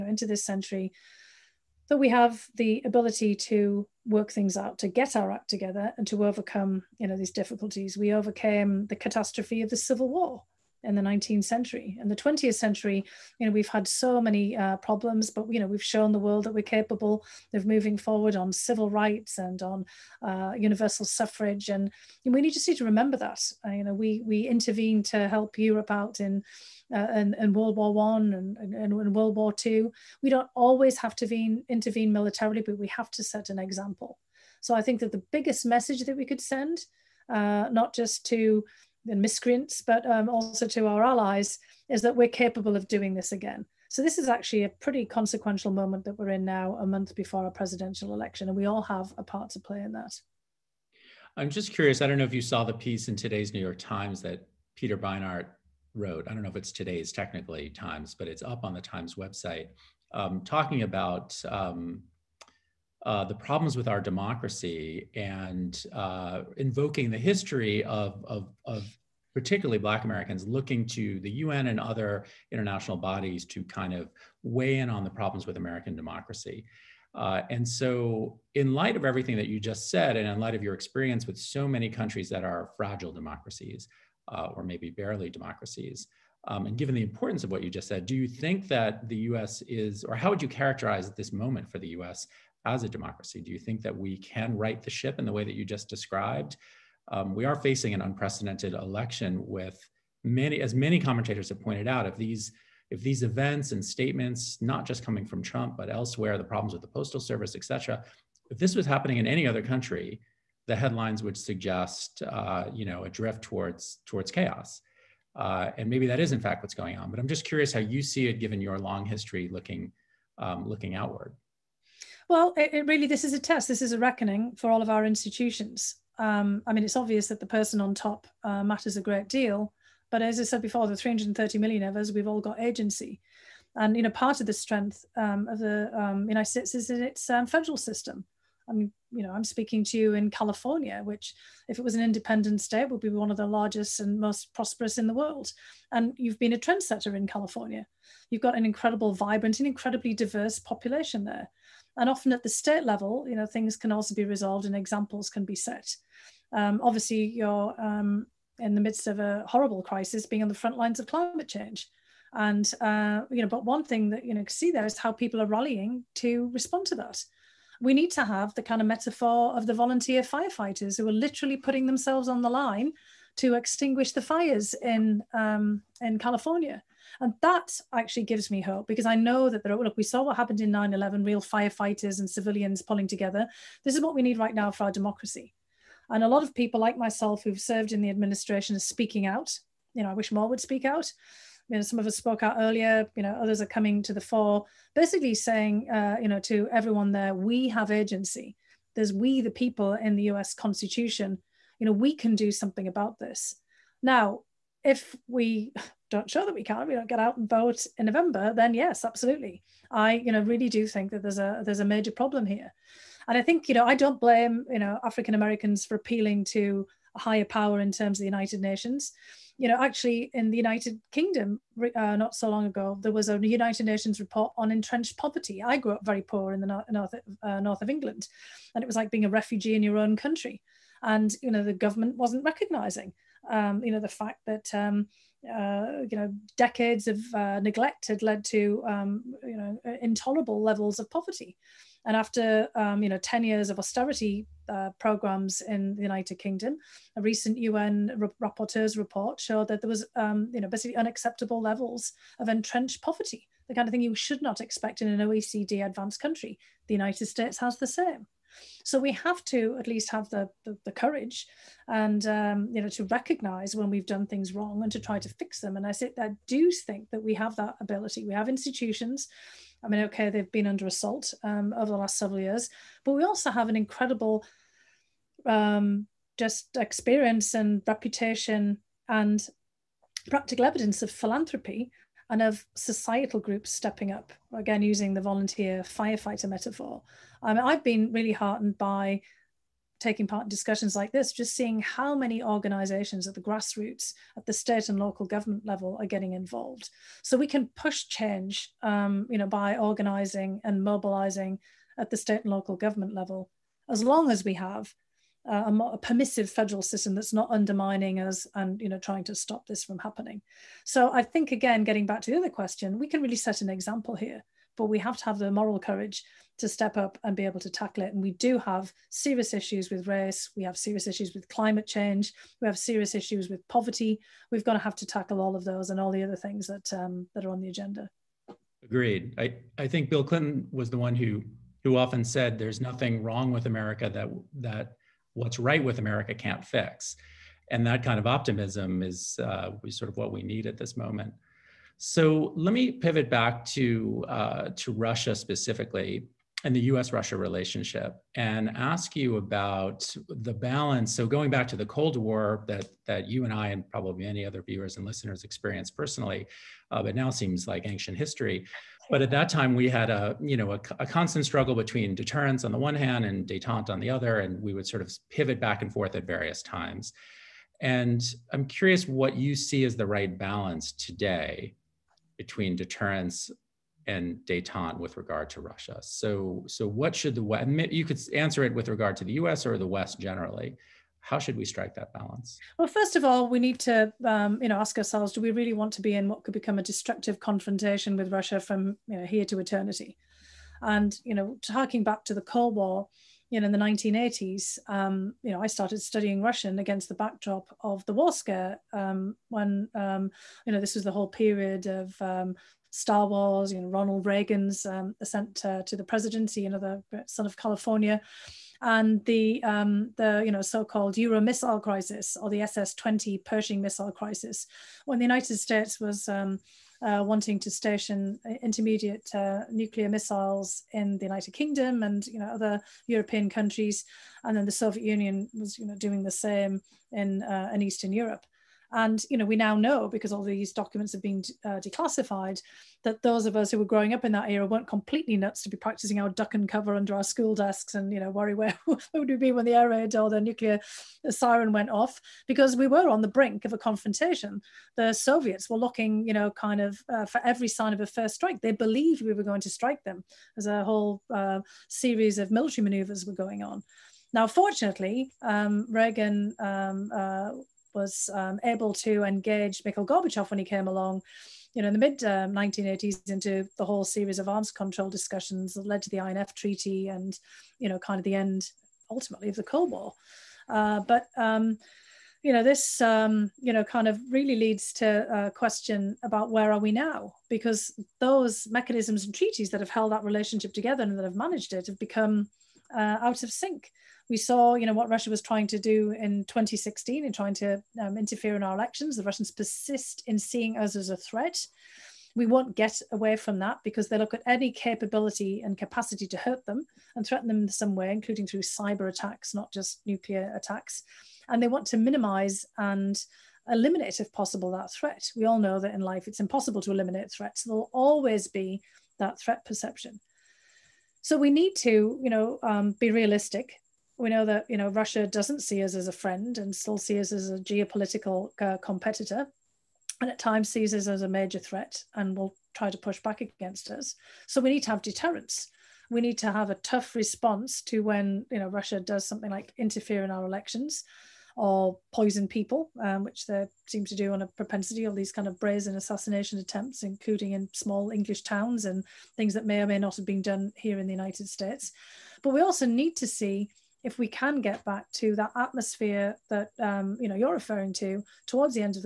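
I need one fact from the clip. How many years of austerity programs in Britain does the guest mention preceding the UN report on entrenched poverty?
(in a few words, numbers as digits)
10.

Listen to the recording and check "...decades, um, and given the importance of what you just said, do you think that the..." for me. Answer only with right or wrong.
wrong.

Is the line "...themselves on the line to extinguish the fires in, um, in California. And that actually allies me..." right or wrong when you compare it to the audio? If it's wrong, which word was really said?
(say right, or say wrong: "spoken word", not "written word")
wrong: "gives", not "allies".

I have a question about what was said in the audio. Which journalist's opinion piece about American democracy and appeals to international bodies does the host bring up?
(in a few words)
Peter Beinart.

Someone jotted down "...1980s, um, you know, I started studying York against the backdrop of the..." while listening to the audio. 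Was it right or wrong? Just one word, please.
wrong.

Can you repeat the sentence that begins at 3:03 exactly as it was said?
This is what we need right now for our democracy.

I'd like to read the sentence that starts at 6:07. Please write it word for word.
And I'm curious what you see as the right balance today between deterrence and detente with regard to Russia.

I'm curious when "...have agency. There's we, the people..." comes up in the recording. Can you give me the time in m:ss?
3:17.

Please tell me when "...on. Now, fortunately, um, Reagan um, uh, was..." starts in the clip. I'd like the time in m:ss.
7:33.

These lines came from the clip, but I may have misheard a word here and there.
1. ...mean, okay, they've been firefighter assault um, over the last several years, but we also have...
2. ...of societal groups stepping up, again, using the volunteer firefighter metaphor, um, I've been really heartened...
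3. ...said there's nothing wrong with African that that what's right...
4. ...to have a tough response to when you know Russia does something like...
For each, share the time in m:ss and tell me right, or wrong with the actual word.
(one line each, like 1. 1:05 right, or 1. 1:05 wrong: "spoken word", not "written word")
1. 4:29 wrong: "under", not "firefighter"
2. 4:42 right
3. 5:32 wrong: "America", not "African"
4. 8:46 right.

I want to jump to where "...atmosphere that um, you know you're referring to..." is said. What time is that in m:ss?
9:05.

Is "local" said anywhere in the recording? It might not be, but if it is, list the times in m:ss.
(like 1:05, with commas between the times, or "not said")
4:54, 5:02.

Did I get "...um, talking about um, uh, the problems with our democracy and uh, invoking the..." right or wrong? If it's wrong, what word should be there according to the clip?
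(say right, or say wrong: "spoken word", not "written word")
right.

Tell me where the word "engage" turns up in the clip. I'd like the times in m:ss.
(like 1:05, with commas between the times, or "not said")
7:39.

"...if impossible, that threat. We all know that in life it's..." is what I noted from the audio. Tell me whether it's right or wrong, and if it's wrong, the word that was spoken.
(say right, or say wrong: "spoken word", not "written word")
wrong: "possible", not "impossible".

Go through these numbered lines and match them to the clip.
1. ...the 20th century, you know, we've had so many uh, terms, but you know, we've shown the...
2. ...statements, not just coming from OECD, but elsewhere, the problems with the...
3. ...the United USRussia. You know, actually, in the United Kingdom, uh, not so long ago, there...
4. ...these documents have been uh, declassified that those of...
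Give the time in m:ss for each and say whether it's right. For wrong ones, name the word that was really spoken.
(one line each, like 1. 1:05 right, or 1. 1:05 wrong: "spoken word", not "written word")
1. 0:12 wrong: "problems", not "terms"
2. 1:43 wrong: "Trump", not "OECD"
3. 3:38 wrong: "Nations", not "USRussia"
4. 7:10 right.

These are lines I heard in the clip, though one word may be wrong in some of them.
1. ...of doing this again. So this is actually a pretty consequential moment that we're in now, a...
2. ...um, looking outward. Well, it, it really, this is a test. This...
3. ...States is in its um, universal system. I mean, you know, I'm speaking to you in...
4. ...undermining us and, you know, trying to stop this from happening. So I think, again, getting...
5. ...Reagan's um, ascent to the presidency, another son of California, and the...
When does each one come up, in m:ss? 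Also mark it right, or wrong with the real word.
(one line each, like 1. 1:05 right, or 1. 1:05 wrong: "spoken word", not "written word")
1. 0:42 right
2. 2:00 right
3. 2:16 wrong: "federal", not "universal"
4. 5:07 right
5. 6:44 right.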